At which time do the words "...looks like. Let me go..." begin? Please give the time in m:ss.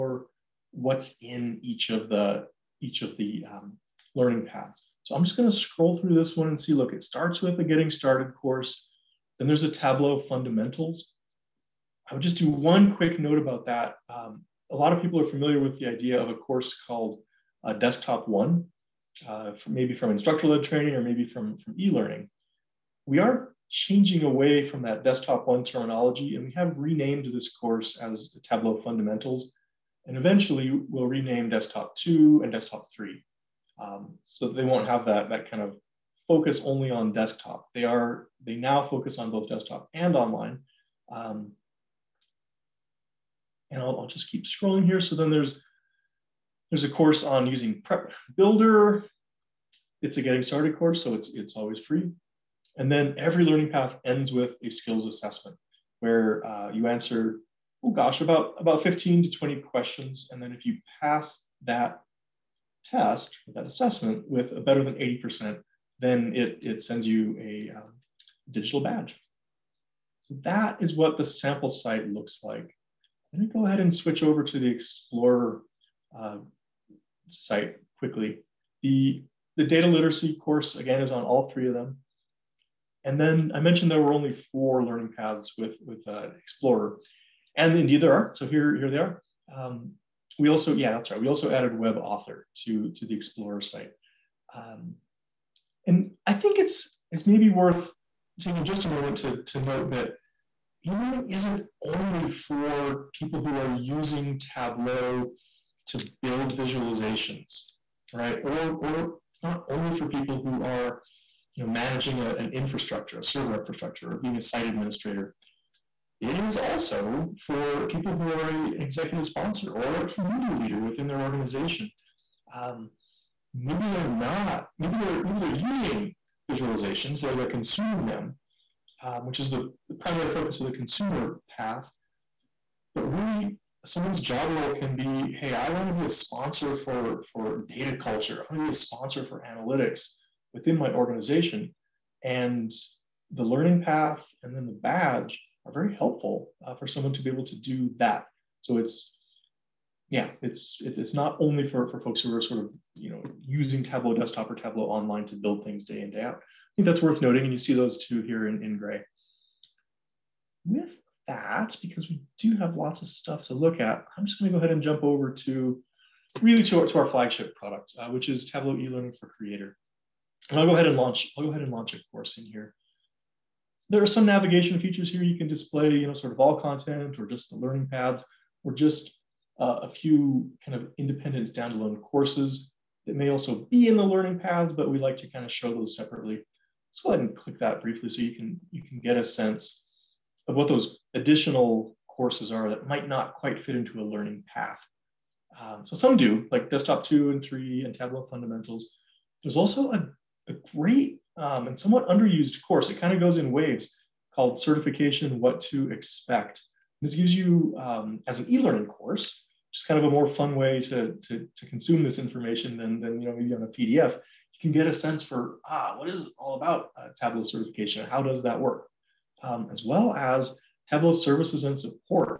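1:12.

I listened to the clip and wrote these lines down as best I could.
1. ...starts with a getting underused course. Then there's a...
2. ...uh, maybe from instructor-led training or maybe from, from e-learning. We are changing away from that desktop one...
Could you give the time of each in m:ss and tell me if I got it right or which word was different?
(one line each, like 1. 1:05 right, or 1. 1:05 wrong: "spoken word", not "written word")
1. 0:07 wrong: "started", not "underused"
2. 0:19 right.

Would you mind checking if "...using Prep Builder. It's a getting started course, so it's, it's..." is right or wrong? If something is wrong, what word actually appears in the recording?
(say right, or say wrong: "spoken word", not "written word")
right.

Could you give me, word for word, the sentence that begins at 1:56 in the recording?
It is also for people who are a, an executive sponsor or a community leader within their organization.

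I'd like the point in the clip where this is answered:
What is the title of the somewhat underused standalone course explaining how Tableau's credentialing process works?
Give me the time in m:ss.
3:24.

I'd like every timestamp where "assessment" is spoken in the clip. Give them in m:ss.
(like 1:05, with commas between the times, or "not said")
0:55, 1:03.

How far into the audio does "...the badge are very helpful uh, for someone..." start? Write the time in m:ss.
2:24.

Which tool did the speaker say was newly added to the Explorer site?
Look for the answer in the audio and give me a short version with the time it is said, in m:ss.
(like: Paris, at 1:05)
web author, at 1:31.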